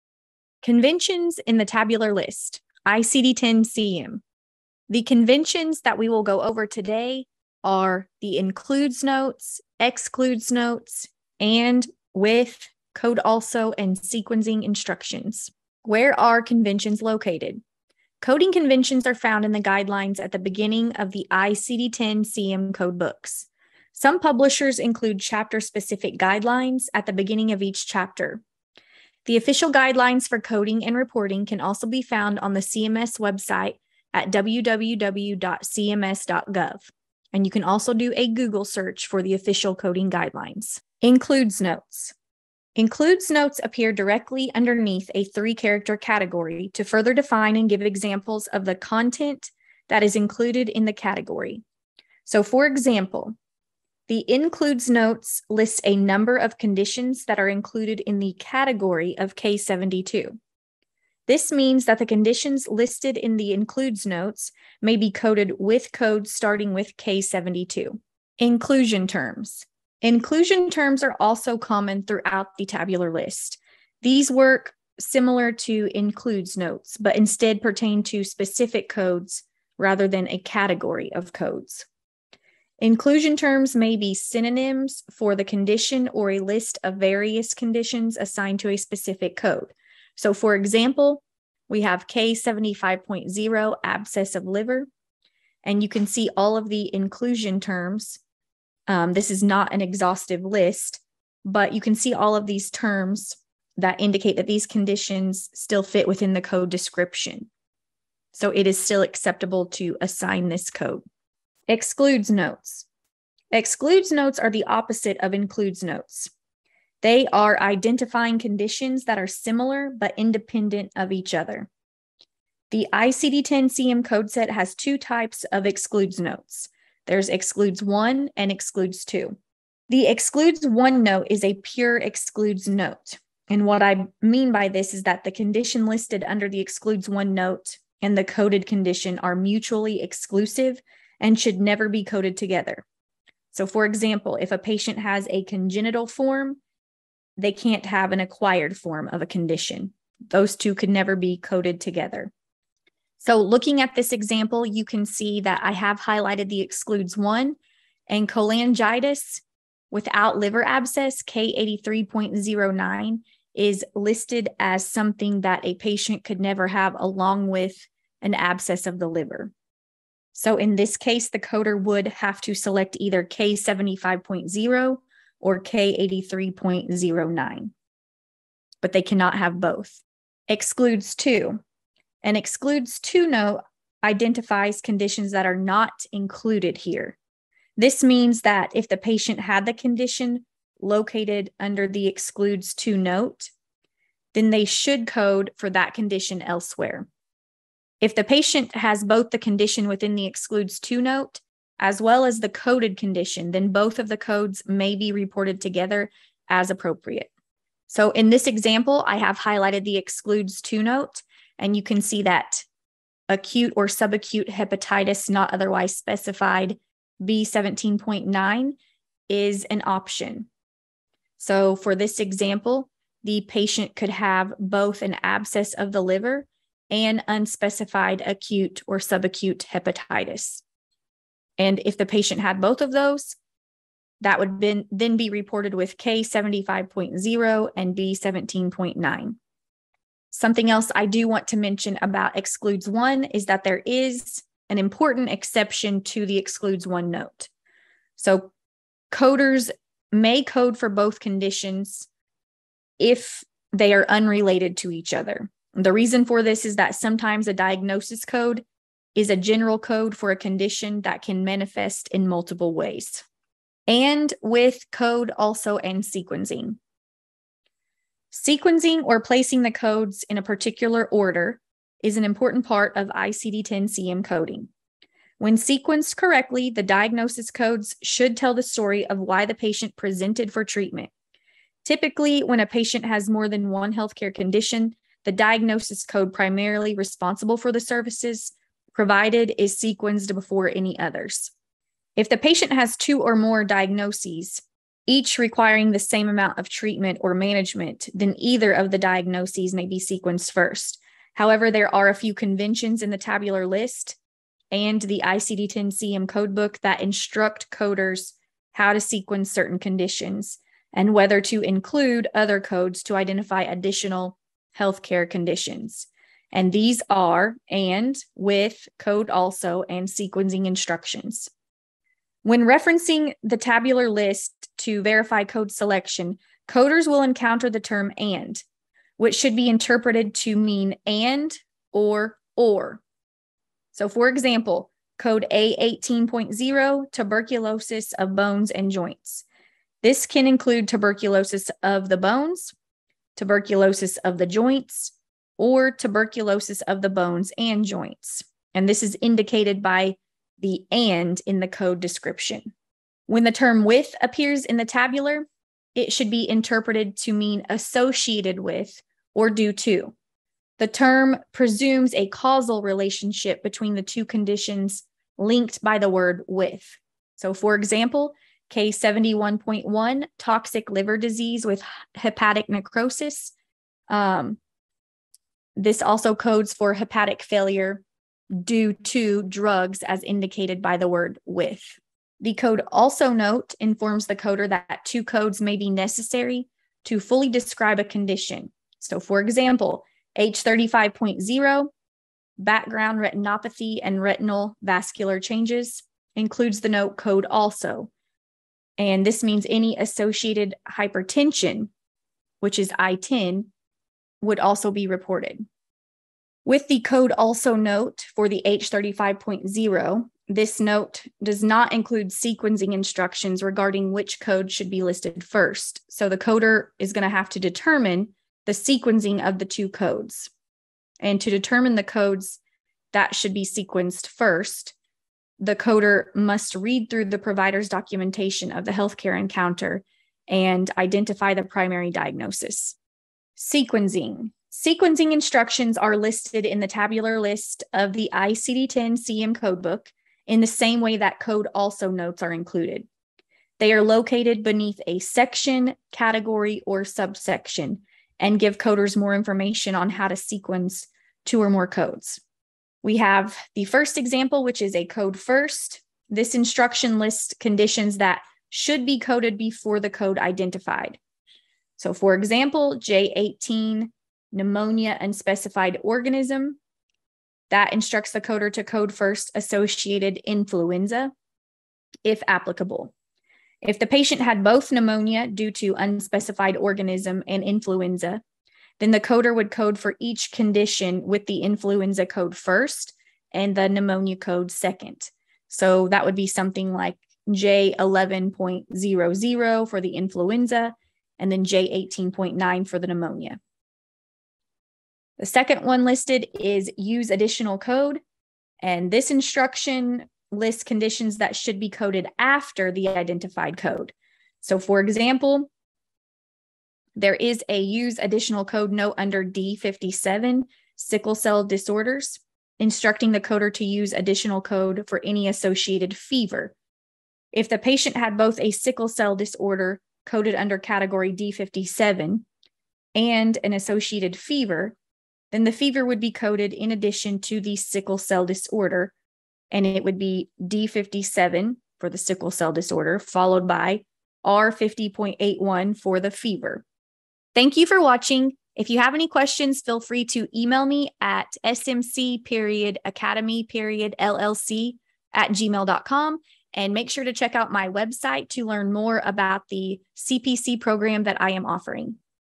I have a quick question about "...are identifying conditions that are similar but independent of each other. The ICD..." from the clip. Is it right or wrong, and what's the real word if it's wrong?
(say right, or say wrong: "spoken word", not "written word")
right.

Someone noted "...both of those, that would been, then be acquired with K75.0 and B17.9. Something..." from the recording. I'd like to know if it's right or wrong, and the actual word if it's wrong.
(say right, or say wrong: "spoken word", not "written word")
wrong: "reported", not "acquired".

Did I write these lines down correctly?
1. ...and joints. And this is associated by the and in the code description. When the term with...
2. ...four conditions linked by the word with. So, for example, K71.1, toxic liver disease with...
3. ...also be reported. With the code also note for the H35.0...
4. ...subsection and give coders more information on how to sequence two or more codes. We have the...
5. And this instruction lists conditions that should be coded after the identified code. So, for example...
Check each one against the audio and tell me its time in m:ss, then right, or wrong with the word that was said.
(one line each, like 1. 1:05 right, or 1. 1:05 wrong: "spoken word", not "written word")
1. 5:47 wrong: "indicated", not "associated"
2. 6:04 wrong: "two", not "four"
3. 6:44 right
4. 7:27 right
5. 8:18 right.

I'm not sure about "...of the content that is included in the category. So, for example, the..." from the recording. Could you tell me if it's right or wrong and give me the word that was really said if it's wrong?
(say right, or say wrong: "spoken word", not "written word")
right.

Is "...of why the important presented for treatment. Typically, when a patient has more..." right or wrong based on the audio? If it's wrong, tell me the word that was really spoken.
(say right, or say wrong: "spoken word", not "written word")
wrong: "patient", not "important".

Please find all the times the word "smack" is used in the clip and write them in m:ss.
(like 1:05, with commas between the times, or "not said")
not said.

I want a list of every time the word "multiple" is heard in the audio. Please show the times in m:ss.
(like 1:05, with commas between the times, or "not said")
4:22.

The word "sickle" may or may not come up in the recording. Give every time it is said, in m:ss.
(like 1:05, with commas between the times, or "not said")
8:30, 8:38, 8:47, 8:52.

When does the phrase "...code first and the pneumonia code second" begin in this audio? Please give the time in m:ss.
8:02.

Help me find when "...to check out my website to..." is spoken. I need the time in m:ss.
9:07.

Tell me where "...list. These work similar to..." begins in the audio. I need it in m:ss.
1:13.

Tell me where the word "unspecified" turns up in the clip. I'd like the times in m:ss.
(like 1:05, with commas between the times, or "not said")
3:47, 7:45, 7:55.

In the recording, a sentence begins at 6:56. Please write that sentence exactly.
So the coder is going to have to determine the sequencing of the two codes.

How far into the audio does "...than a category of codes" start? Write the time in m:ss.
1:20.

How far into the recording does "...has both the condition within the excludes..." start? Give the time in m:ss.
3:18.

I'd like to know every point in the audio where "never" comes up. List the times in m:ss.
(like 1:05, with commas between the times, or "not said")
2:21, 2:30, 2:46.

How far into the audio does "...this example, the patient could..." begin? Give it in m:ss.
3:41.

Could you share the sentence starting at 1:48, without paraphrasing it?
So, it is still acceptable to assign this code.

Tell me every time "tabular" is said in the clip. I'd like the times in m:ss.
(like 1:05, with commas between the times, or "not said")
0:01, 1:12, 5:03, 5:23, 5:54, 7:16.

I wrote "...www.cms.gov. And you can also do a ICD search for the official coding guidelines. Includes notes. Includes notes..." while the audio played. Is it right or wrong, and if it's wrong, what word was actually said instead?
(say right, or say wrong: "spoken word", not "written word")
wrong: "Google", not "ICD".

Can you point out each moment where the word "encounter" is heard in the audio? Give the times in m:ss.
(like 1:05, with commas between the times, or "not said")
5:27, 7:09.